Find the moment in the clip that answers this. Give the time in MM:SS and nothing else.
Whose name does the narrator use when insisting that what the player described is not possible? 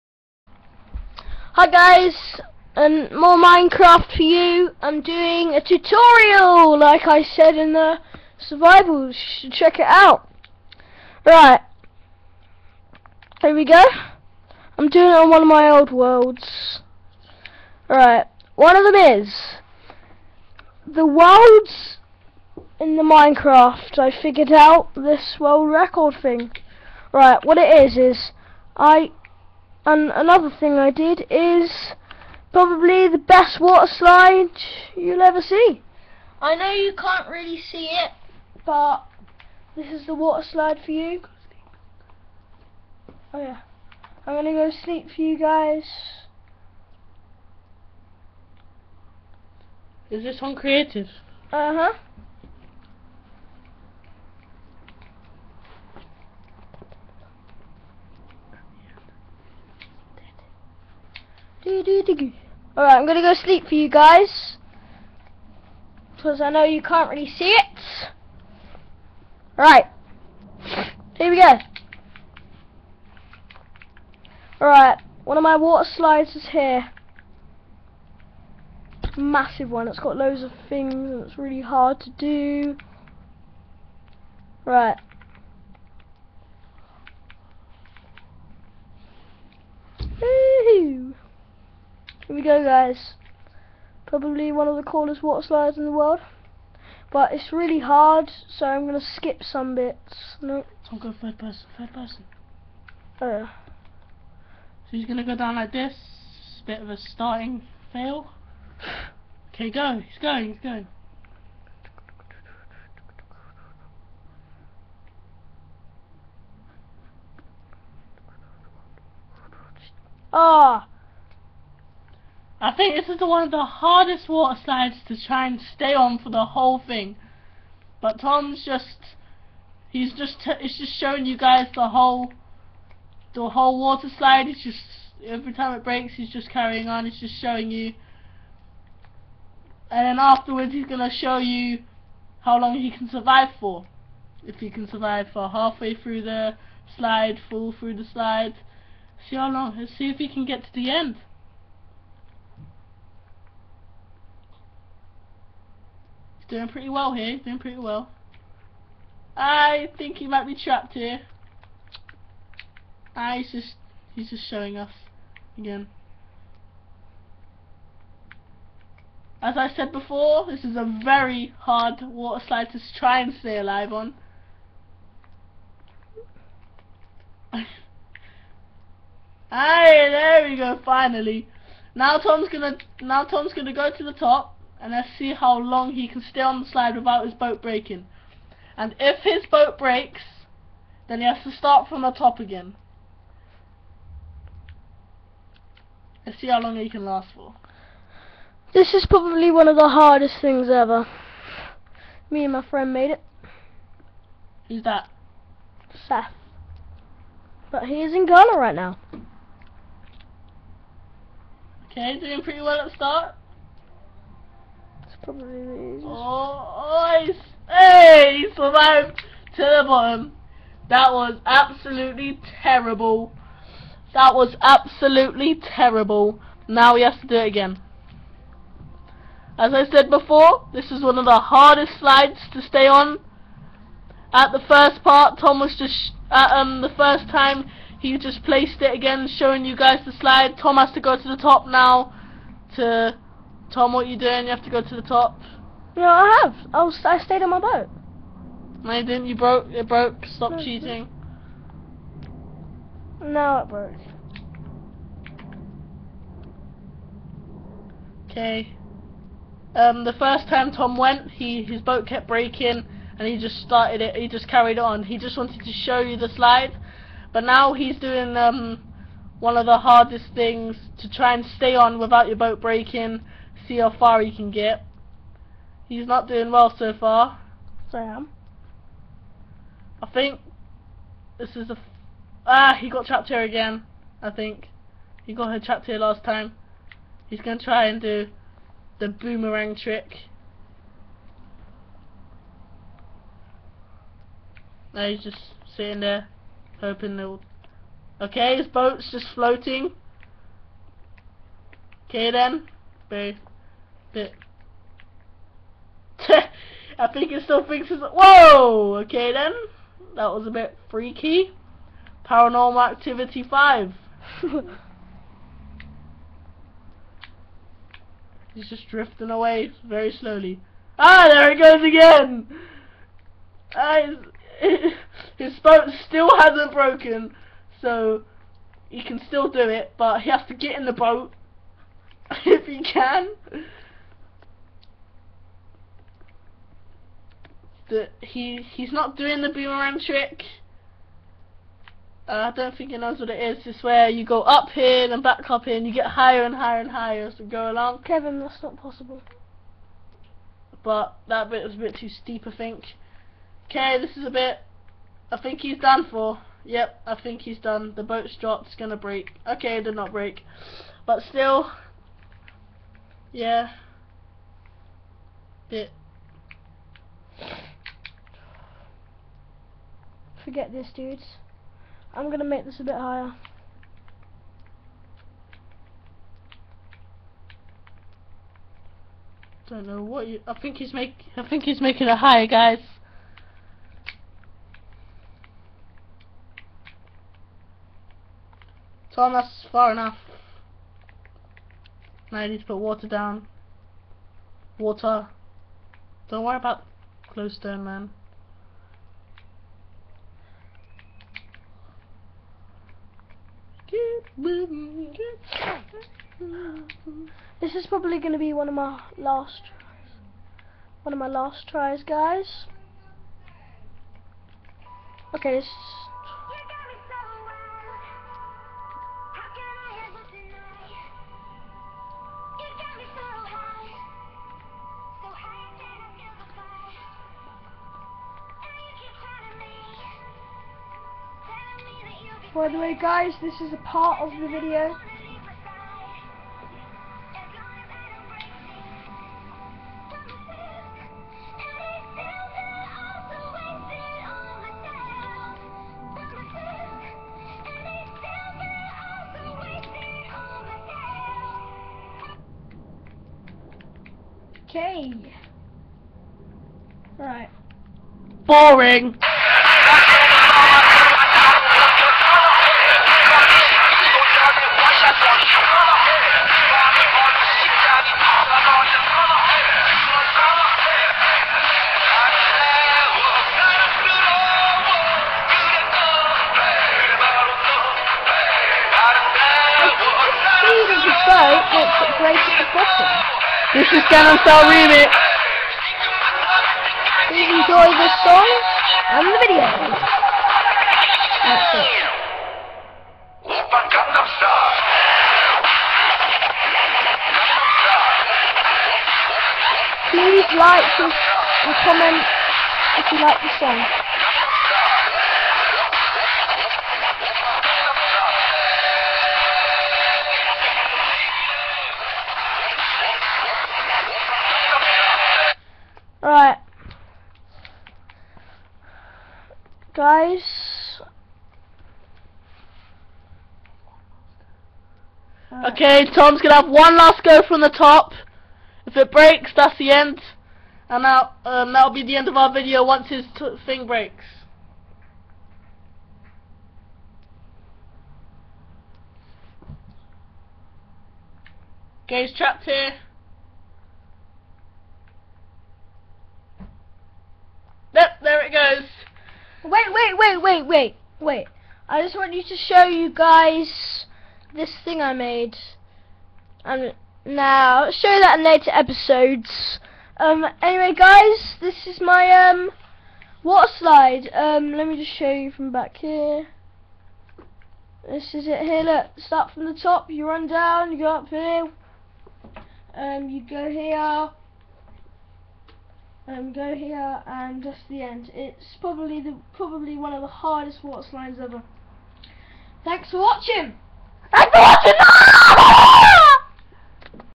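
05:48.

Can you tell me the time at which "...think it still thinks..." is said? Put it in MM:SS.
05:07.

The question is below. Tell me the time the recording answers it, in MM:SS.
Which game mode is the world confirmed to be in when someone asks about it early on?
00:50.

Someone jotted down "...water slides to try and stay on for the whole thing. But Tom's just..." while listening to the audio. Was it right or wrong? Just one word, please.
right.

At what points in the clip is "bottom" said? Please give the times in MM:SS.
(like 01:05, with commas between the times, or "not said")
03:39, 08:02.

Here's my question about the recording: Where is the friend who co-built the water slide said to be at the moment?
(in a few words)
Ghana.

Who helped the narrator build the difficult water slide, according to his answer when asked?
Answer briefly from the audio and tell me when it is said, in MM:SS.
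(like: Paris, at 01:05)
Seth, at 03:26.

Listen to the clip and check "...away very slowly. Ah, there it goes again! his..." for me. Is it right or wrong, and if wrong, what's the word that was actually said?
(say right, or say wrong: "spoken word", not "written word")
right.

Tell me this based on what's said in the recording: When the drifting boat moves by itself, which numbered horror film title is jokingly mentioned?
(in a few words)
Paranormal Activity 5.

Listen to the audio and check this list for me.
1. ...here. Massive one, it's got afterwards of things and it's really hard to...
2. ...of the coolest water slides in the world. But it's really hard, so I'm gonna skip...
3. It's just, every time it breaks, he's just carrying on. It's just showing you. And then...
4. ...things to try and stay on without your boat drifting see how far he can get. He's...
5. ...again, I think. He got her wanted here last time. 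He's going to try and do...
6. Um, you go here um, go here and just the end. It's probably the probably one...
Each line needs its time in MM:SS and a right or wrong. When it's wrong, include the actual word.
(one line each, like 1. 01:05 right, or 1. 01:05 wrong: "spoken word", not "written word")
1. 01:16 wrong: "loads", not "afterwards"
2. 01:34 right
3. 02:14 right
4. 04:30 wrong: "breaking", not "drifting"
5. 04:43 wrong: "trapped", not "wanted"
6. 09:32 right.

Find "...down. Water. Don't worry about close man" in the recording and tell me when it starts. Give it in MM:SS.
06:33.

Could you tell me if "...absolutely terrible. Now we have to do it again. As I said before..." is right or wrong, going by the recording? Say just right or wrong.
right.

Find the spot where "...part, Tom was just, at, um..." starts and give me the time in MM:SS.
03:55.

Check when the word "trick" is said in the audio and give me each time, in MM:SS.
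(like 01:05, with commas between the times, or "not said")
04:49, 05:39.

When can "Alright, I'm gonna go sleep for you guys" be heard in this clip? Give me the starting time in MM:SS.
01:01.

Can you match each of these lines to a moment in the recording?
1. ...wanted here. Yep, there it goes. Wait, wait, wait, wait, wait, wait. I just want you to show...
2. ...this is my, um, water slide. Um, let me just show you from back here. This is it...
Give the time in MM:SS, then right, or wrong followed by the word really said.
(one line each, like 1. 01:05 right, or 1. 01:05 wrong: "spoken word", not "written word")
1. 09:02 wrong: "trapped", not "wanted"
2. 09:21 right.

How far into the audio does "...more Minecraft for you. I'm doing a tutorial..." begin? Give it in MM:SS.
00:03.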